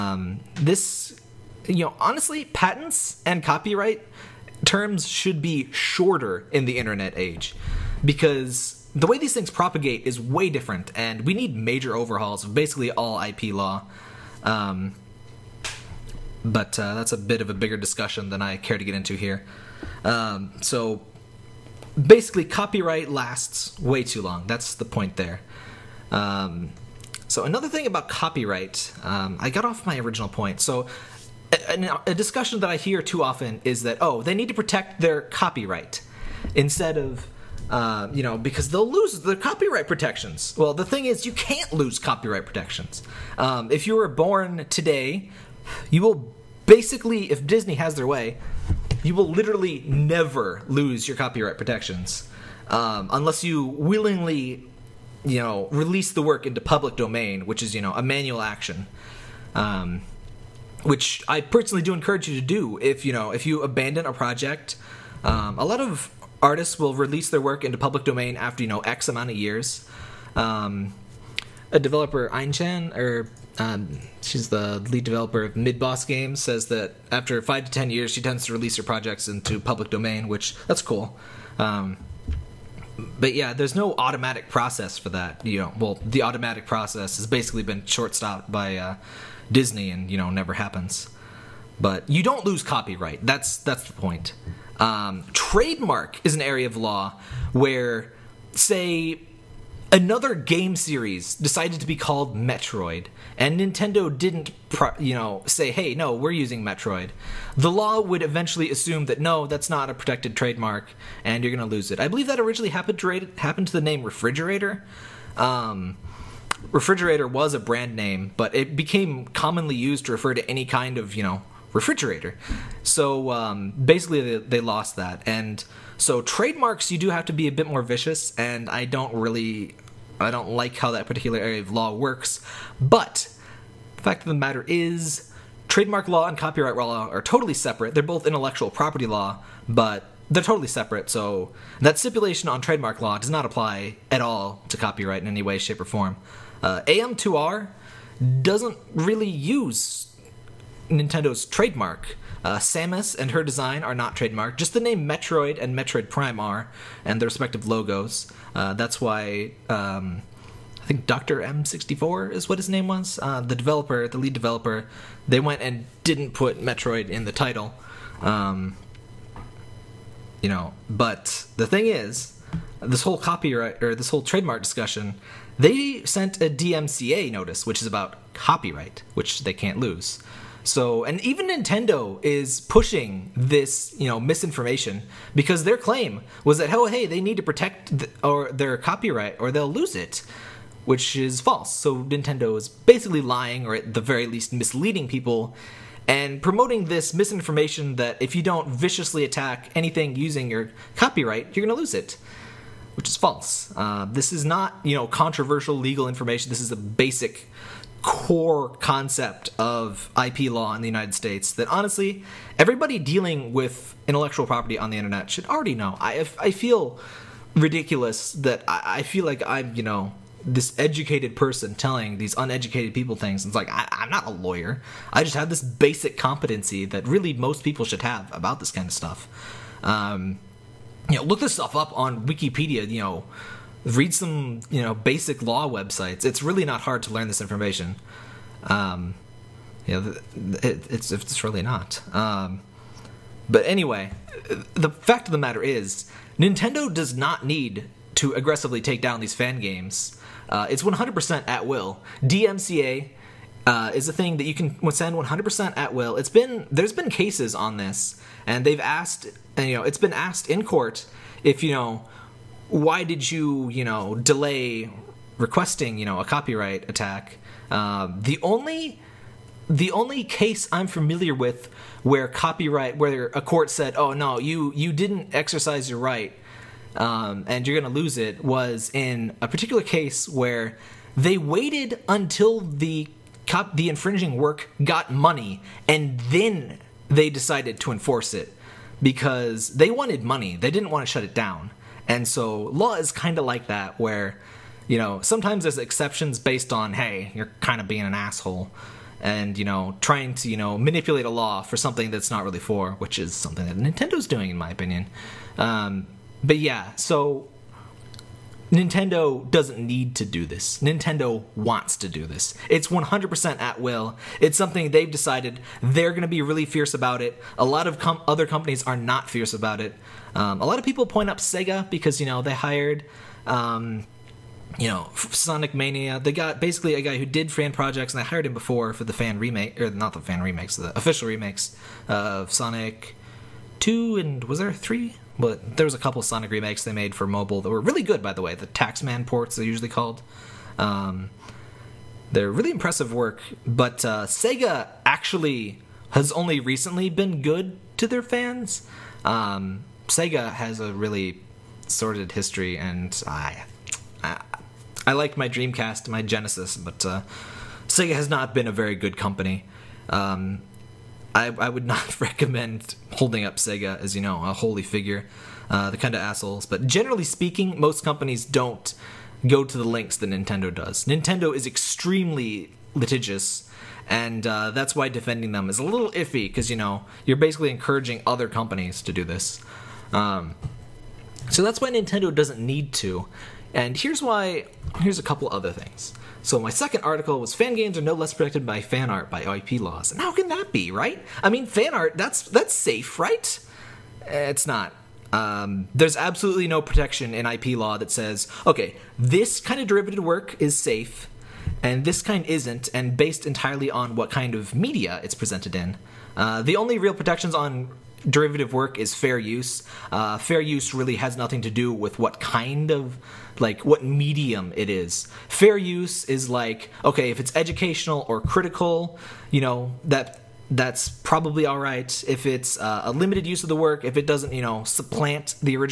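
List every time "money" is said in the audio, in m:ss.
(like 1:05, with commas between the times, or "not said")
4:45, 4:50.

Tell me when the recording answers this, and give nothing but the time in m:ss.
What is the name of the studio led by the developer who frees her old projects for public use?
1:15.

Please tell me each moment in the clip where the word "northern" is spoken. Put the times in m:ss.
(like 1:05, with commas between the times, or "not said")
not said.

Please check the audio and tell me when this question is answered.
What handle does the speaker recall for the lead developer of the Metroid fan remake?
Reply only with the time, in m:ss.
2:41.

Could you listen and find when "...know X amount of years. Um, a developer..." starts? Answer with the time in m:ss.
1:08.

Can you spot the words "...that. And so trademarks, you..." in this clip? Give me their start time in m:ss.
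2:04.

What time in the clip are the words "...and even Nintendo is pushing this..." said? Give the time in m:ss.
3:01.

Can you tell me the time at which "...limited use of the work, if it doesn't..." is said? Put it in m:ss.
7:03.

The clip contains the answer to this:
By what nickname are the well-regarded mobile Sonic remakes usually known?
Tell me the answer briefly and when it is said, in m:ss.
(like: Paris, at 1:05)
The Taxman ports, at 5:38.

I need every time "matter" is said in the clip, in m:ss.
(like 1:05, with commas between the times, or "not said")
2:14, 4:05.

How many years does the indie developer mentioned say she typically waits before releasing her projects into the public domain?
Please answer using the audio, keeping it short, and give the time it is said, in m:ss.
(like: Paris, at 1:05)
5 to 10 years, at 1:17.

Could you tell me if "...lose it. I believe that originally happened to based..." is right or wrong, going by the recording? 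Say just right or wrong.
wrong.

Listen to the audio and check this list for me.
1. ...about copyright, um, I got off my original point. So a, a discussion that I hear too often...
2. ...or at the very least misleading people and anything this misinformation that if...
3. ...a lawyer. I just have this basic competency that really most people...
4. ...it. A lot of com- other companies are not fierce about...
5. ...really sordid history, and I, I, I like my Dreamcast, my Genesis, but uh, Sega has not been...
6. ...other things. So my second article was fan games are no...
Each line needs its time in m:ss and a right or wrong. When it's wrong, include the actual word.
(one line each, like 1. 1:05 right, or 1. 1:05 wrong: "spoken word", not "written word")
1. 0:27 right
2. 3:13 wrong: "promoting", not "anything"
3. 3:44 right
4. 5:17 right
5. 5:50 right
6. 6:25 right.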